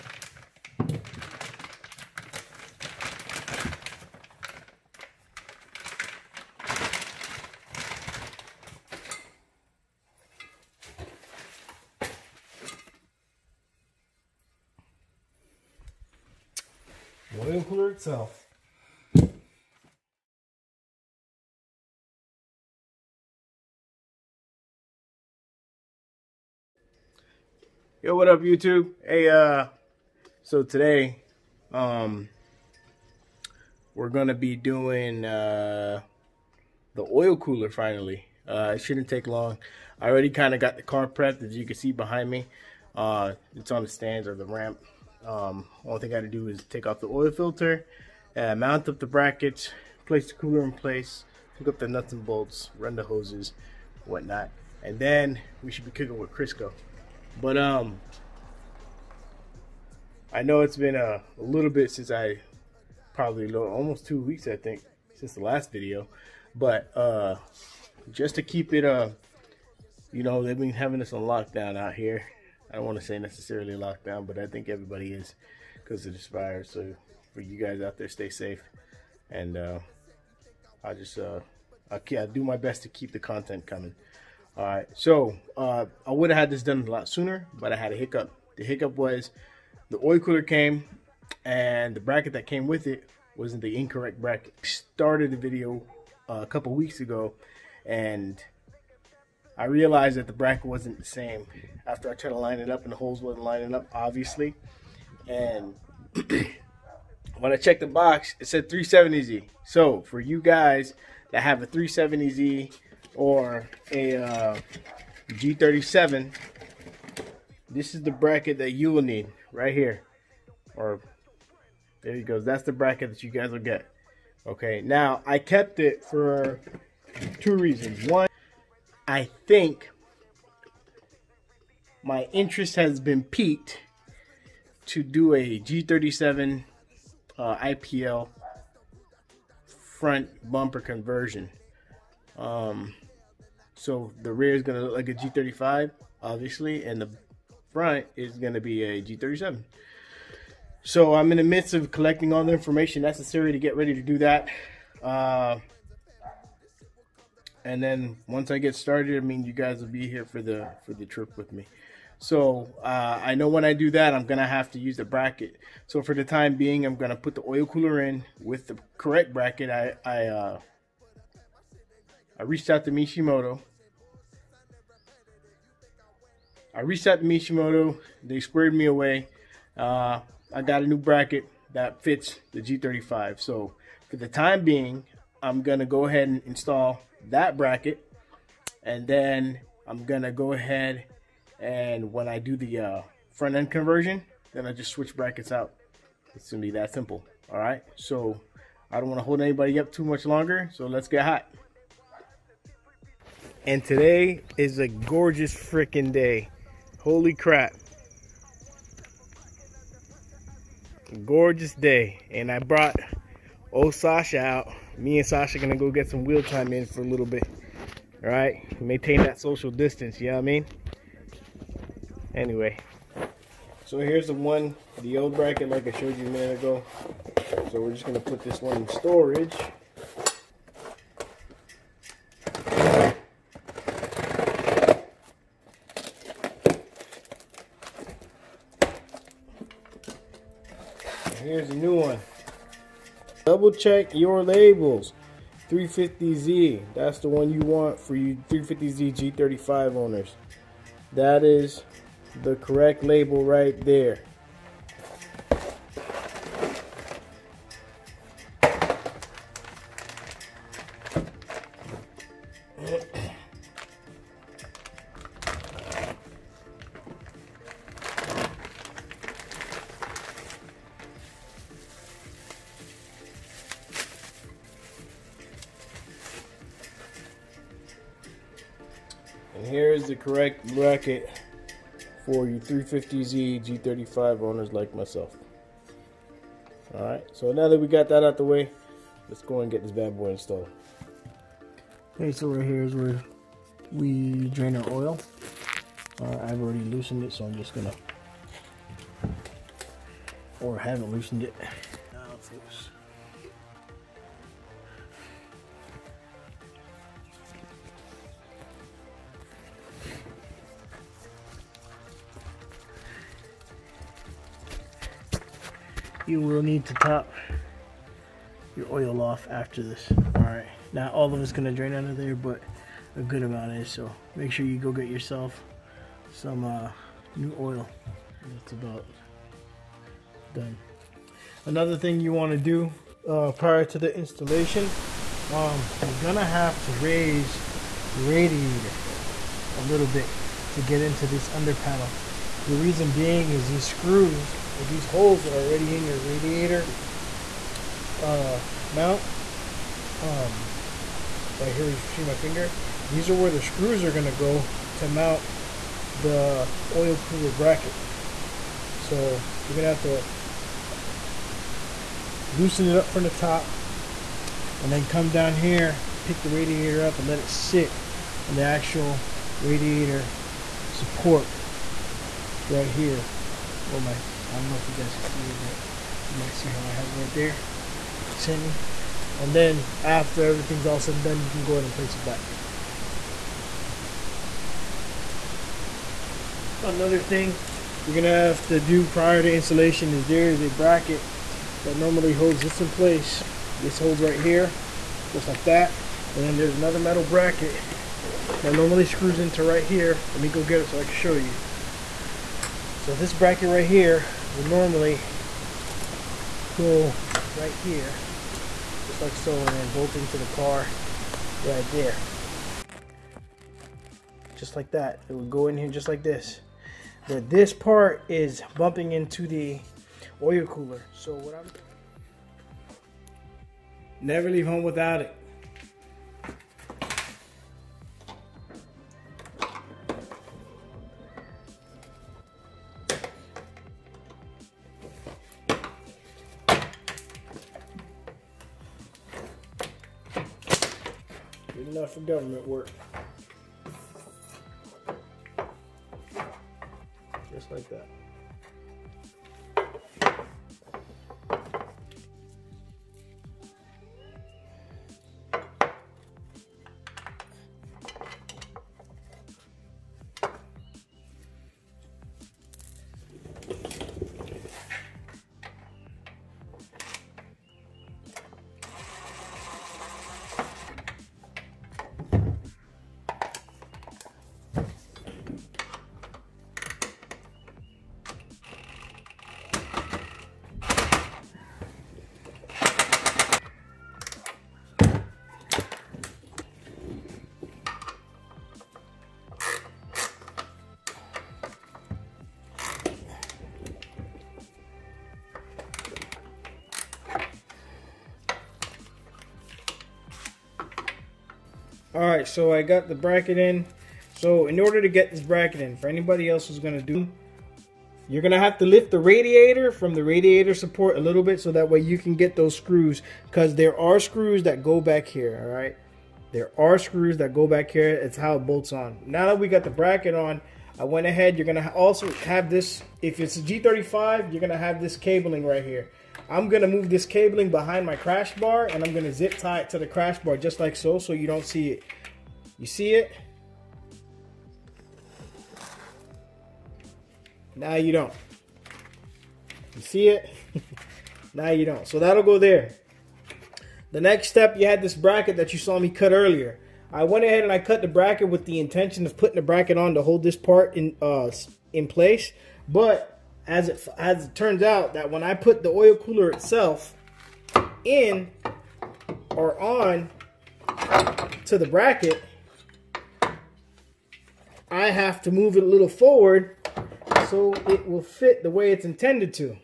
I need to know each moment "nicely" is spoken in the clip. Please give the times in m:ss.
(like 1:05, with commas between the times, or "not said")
not said.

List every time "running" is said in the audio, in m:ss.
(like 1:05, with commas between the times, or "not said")
not said.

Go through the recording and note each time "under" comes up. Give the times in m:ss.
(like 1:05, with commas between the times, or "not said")
5:41.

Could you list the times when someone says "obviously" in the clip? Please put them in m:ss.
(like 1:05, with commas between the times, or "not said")
1:43, 2:26.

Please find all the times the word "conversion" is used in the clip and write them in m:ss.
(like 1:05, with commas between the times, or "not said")
2:20, 3:13.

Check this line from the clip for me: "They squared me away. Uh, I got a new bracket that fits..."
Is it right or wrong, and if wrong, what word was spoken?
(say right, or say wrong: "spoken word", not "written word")
right.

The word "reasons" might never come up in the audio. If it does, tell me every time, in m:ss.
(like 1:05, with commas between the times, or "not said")
2:07, 5:42.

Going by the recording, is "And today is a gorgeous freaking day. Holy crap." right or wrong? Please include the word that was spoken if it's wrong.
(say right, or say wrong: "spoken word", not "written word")
right.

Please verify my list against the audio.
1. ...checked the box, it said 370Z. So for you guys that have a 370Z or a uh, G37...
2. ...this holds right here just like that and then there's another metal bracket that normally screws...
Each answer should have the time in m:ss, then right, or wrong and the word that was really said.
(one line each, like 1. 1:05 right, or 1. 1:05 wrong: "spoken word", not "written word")
1. 1:47 right
2. 6:33 right.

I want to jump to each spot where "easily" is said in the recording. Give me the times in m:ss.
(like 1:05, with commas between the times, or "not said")
not said.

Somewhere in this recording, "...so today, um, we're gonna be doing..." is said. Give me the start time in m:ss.
0:30.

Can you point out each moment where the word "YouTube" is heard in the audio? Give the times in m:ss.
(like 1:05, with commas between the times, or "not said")
0:28.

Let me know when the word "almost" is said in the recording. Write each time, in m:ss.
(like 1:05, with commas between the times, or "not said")
1:03.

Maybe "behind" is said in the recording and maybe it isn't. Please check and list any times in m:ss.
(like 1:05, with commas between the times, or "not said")
0:41, 8:47.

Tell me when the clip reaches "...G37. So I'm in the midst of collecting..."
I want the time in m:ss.
2:29.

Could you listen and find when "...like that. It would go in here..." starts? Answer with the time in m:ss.
6:54.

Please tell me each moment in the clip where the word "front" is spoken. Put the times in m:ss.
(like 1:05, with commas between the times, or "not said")
2:19, 2:27, 3:13.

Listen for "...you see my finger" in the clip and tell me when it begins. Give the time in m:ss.
5:51.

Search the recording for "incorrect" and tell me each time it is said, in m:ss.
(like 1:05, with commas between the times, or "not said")
1:33.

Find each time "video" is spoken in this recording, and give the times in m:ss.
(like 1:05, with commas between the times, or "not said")
1:05, 1:35.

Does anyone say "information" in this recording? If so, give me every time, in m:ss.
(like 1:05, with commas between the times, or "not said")
2:32.